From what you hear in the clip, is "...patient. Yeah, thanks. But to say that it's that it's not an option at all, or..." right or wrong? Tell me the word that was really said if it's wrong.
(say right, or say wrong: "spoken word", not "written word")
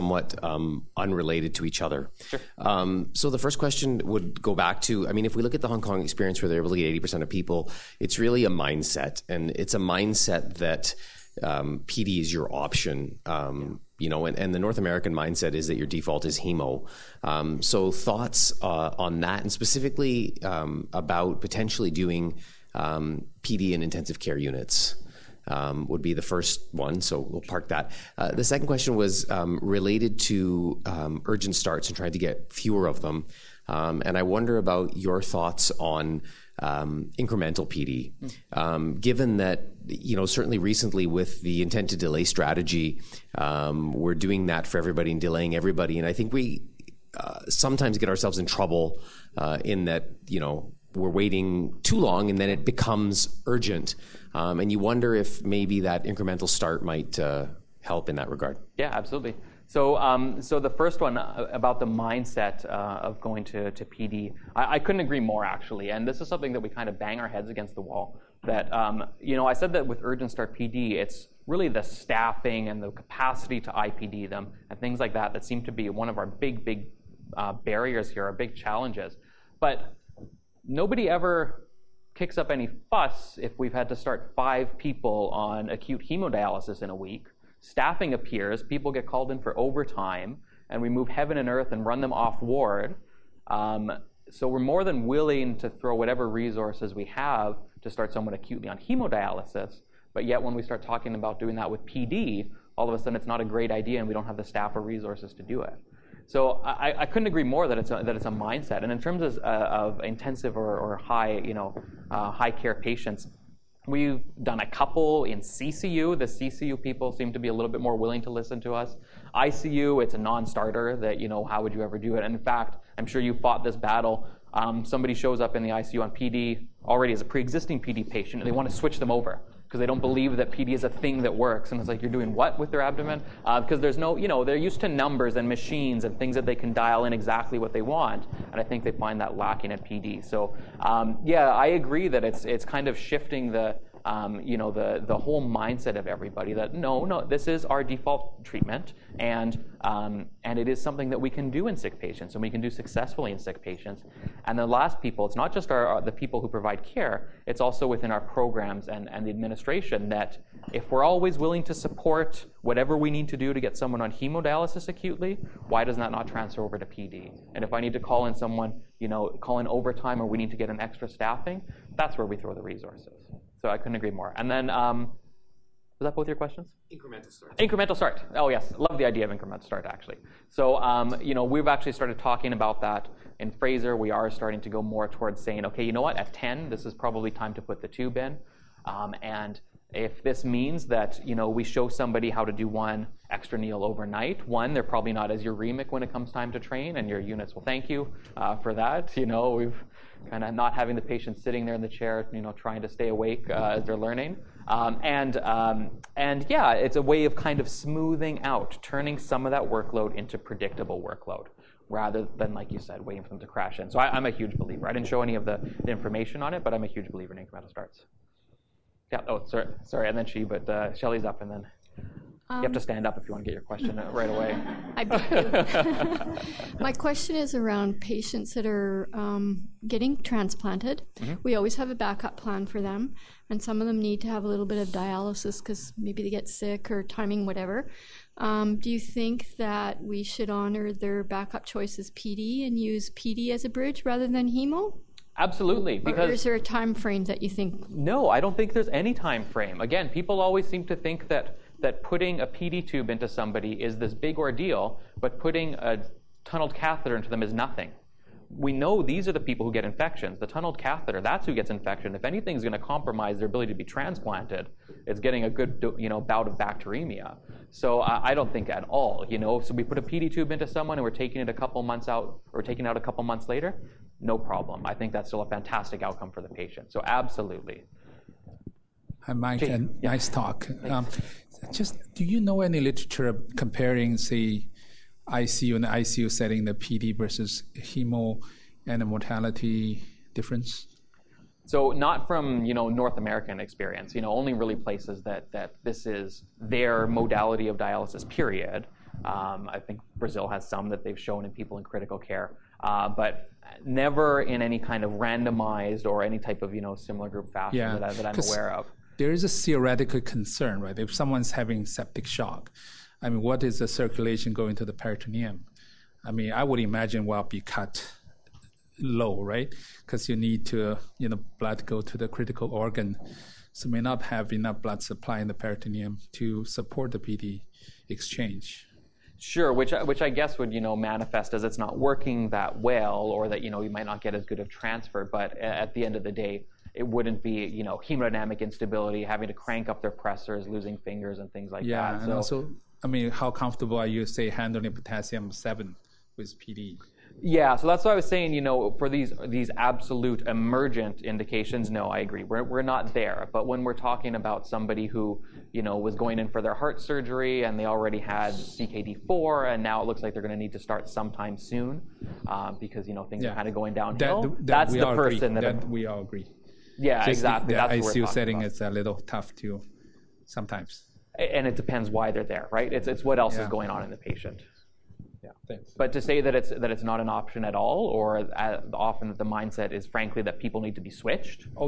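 right.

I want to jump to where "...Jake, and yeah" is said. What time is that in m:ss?
4:39.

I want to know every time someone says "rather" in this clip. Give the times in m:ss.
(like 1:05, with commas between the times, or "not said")
3:31, 4:04.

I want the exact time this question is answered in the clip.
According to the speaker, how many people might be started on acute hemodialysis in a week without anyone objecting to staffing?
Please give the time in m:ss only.
1:24.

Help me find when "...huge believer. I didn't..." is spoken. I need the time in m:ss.
3:34.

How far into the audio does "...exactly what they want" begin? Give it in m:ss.
2:17.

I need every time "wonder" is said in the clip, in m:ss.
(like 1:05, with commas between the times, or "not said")
0:34, 0:54.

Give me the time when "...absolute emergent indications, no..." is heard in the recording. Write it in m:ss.
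5:49.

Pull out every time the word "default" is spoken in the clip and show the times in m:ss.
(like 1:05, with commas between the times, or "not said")
0:15, 2:27.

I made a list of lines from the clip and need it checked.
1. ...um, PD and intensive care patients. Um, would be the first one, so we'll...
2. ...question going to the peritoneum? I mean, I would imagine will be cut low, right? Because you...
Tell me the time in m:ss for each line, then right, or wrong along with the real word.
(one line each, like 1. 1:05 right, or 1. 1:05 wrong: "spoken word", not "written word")
1. 0:22 wrong: "units", not "patients"
2. 5:13 wrong: "circulation", not "question".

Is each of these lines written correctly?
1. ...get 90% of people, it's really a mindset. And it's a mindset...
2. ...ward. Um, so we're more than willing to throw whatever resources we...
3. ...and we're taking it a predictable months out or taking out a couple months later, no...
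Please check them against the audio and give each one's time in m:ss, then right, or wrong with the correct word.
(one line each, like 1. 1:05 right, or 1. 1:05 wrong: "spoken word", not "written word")
1. 0:06 wrong: "80", not "90"
2. 1:32 right
3. 4:30 wrong: "couple", not "predictable".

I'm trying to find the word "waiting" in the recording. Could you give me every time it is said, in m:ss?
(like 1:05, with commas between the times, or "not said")
0:51, 3:33.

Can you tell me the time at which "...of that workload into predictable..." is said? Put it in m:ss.
3:29.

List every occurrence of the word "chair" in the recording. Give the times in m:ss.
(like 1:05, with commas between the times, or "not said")
3:21.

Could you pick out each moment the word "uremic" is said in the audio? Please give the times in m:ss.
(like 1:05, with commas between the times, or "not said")
3:15.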